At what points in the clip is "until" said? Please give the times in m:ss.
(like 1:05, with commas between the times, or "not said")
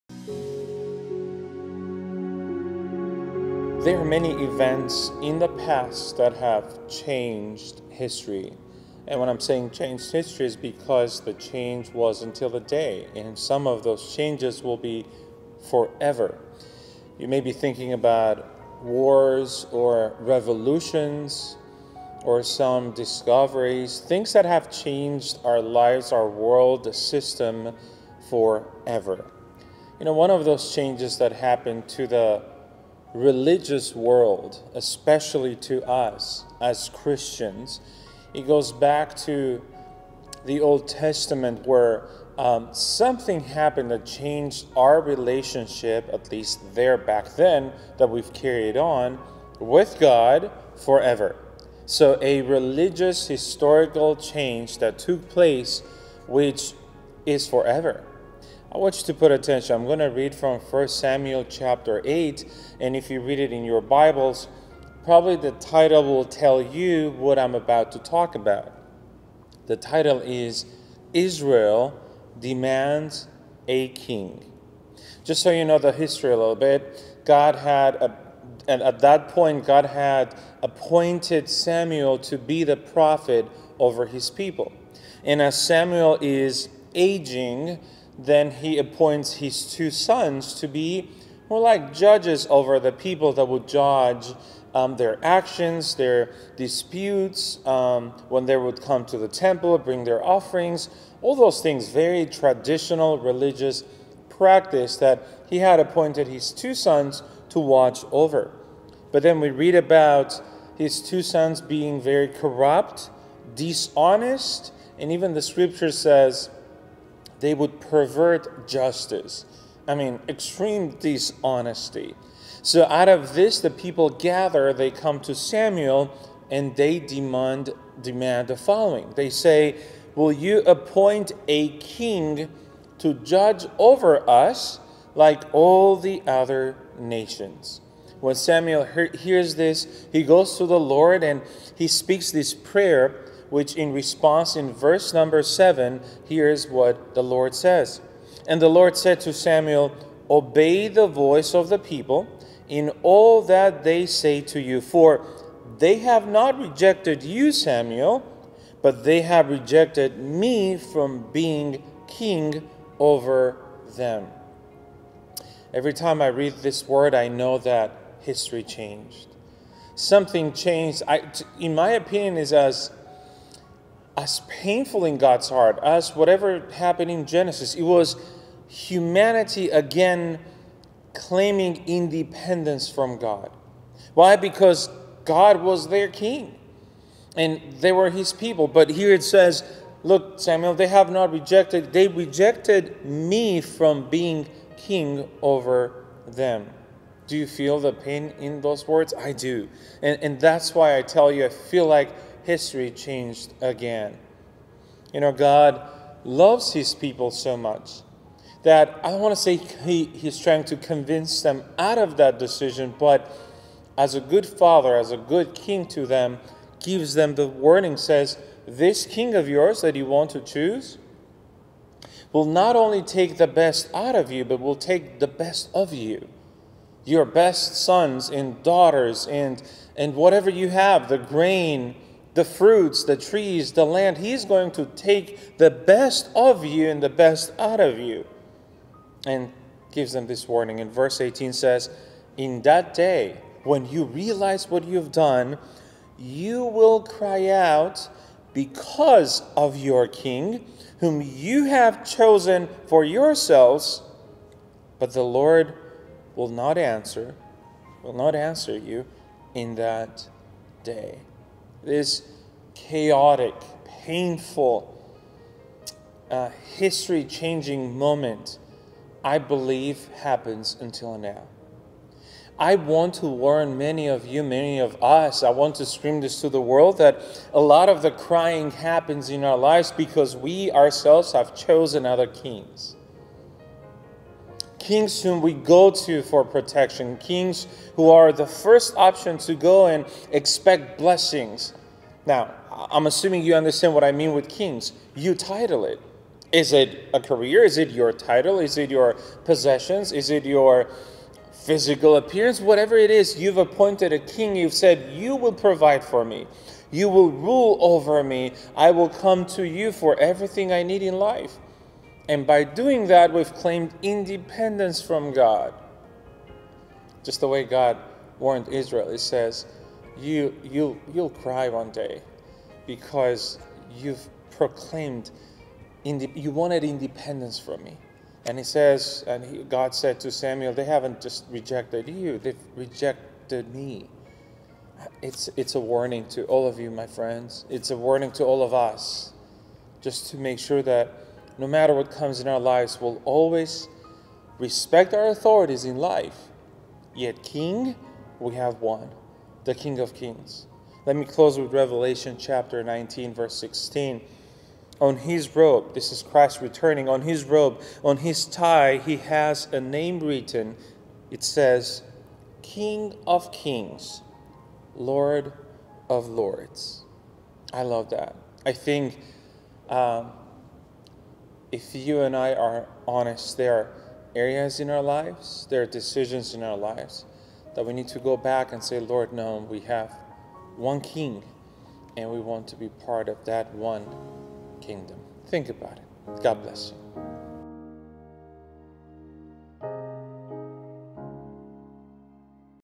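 0:12, 4:30.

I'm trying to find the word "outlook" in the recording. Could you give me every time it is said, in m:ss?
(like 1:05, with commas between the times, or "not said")
not said.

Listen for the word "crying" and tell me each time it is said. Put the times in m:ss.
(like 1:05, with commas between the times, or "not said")
4:38.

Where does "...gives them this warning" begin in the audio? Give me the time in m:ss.
3:59.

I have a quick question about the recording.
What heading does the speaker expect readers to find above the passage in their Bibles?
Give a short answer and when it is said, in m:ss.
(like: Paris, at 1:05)
Israel Demands a King, at 1:11.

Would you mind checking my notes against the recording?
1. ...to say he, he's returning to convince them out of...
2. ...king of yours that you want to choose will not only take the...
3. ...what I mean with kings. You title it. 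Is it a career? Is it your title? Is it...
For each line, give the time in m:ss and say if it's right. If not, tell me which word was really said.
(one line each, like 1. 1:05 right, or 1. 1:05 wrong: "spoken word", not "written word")
1. 3:29 wrong: "trying", not "returning"
2. 3:39 right
3. 4:53 right.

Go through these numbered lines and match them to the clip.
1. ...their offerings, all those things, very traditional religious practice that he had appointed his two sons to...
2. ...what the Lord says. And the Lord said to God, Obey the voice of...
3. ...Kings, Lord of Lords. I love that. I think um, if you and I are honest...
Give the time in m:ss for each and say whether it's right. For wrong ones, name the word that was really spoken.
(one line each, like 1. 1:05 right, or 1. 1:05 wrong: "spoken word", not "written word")
1. 1:40 right
2. 2:26 wrong: "Samuel", not "God"
3. 6:03 right.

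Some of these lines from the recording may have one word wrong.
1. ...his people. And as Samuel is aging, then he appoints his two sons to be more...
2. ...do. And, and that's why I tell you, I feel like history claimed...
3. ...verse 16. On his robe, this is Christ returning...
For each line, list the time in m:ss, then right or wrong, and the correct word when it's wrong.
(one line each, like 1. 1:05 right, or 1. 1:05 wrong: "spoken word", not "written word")
1. 1:24 right
2. 3:19 wrong: "changed", not "claimed"
3. 5:53 right.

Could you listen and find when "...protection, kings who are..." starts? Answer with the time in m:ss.
4:46.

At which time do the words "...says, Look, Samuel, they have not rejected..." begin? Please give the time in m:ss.
3:09.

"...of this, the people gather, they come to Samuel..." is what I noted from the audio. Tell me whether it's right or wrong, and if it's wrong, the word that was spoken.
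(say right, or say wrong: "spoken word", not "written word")
right.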